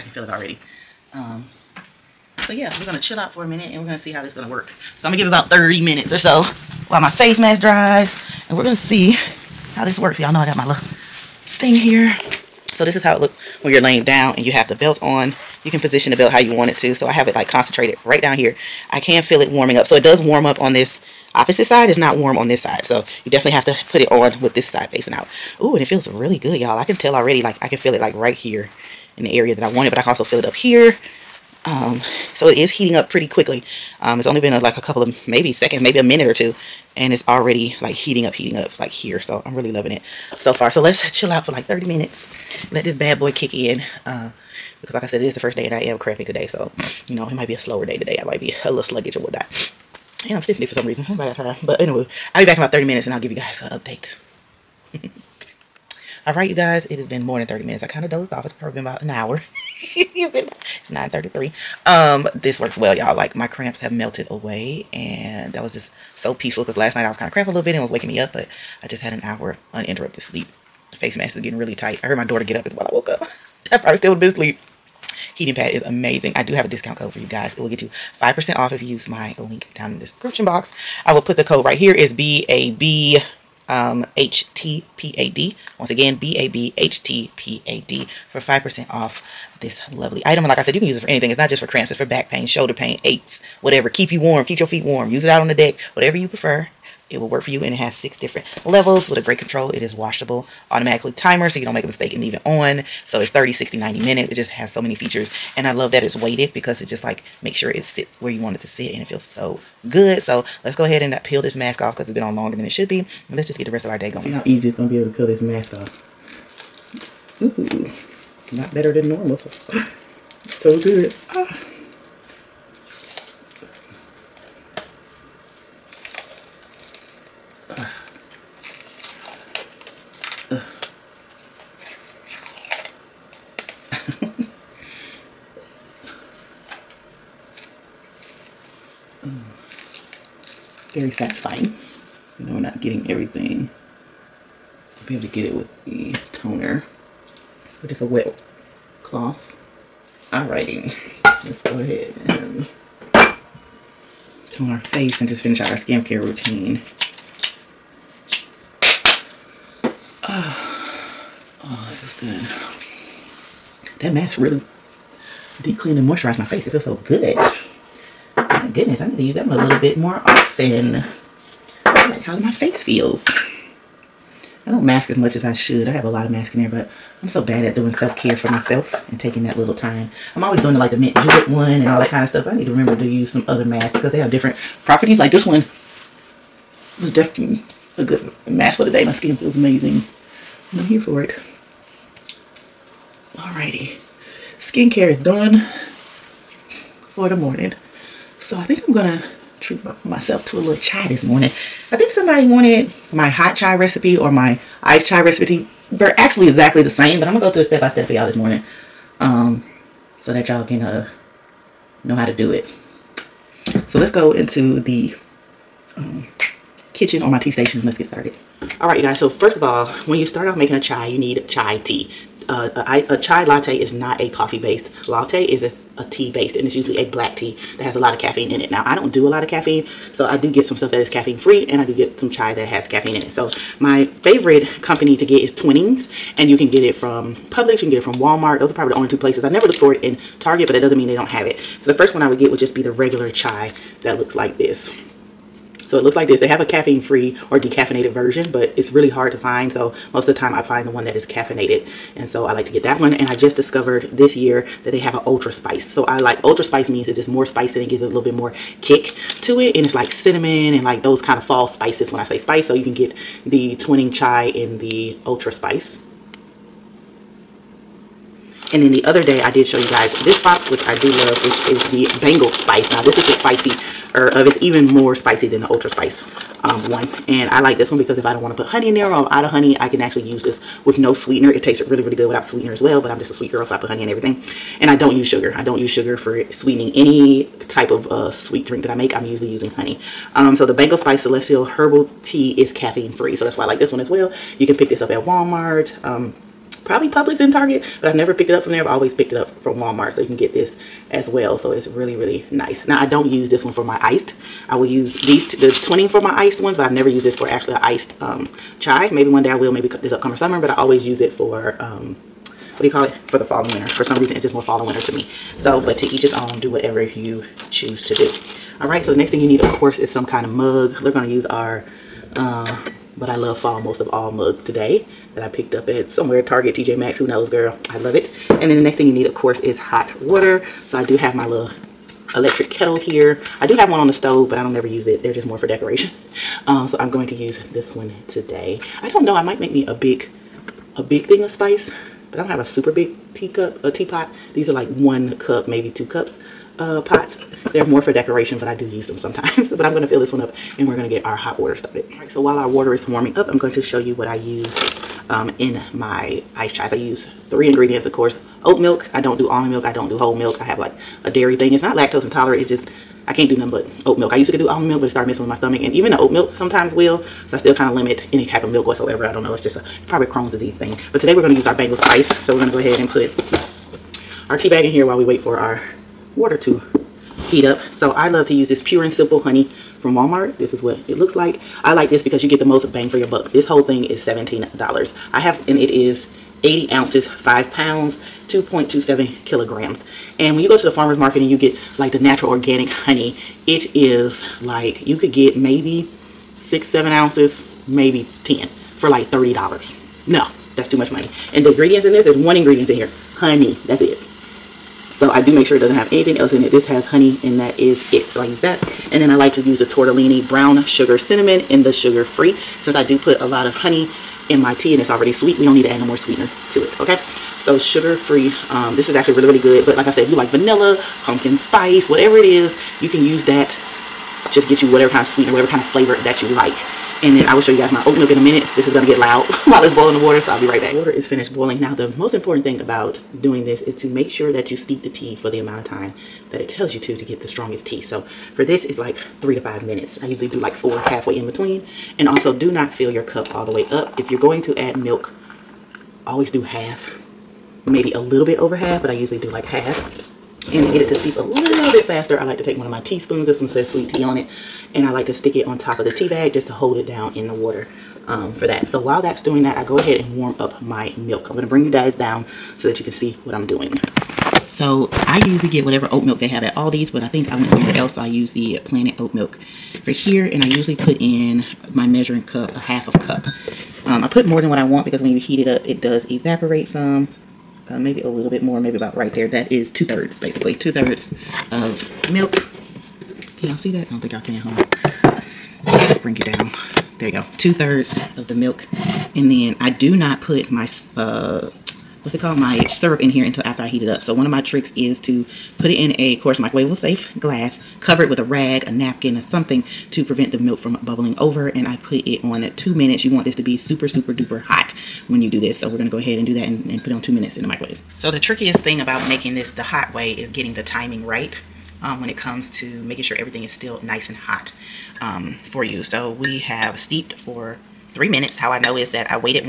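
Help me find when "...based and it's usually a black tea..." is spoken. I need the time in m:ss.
3:46.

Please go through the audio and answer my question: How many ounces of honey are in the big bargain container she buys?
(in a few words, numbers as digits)
80.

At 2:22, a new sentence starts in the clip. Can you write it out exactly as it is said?
You know, we're not getting everything.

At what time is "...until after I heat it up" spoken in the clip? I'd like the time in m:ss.
8:13.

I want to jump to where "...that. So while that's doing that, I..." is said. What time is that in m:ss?
7:38.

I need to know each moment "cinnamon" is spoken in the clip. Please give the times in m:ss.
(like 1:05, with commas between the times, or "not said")
4:20, 6:51.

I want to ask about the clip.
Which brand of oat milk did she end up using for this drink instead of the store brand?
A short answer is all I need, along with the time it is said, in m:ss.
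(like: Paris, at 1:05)
Planet Oat, at 7:48.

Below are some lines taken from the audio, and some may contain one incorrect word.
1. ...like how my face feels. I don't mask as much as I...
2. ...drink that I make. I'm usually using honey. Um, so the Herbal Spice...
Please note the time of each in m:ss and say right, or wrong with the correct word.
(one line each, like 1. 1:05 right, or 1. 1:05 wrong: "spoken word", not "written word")
1. 2:52 right
2. 4:48 wrong: "Bengal", not "Herbal".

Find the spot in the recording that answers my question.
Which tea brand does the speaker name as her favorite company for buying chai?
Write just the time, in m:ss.
3:55.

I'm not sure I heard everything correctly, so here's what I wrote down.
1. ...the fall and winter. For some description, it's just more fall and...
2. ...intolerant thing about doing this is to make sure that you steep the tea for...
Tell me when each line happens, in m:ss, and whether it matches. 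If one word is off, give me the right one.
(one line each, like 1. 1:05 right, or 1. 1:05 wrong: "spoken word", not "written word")
1. 5:13 wrong: "reason", not "description"
2. 7:12 wrong: "important", not "intolerant".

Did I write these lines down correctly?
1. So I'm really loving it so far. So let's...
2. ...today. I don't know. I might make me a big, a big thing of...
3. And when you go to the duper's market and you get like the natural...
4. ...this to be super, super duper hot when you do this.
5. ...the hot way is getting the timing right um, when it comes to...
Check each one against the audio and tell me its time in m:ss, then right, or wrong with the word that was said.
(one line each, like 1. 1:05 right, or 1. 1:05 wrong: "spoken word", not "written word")
1. 0:39 right
2. 5:38 right
3. 6:30 wrong: "farmer", not "duper"
4. 8:23 right
5. 8:29 right.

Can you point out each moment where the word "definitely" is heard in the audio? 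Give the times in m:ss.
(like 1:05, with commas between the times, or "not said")
0:23, 3:07.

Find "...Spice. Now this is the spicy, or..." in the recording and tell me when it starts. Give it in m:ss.
4:32.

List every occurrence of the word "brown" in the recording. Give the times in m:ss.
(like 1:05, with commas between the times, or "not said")
6:50.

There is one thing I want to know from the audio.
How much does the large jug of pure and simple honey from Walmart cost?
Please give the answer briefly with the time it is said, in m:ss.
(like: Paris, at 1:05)
$17, at 6:24.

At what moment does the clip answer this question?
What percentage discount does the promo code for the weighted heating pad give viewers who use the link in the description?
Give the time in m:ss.
1:18.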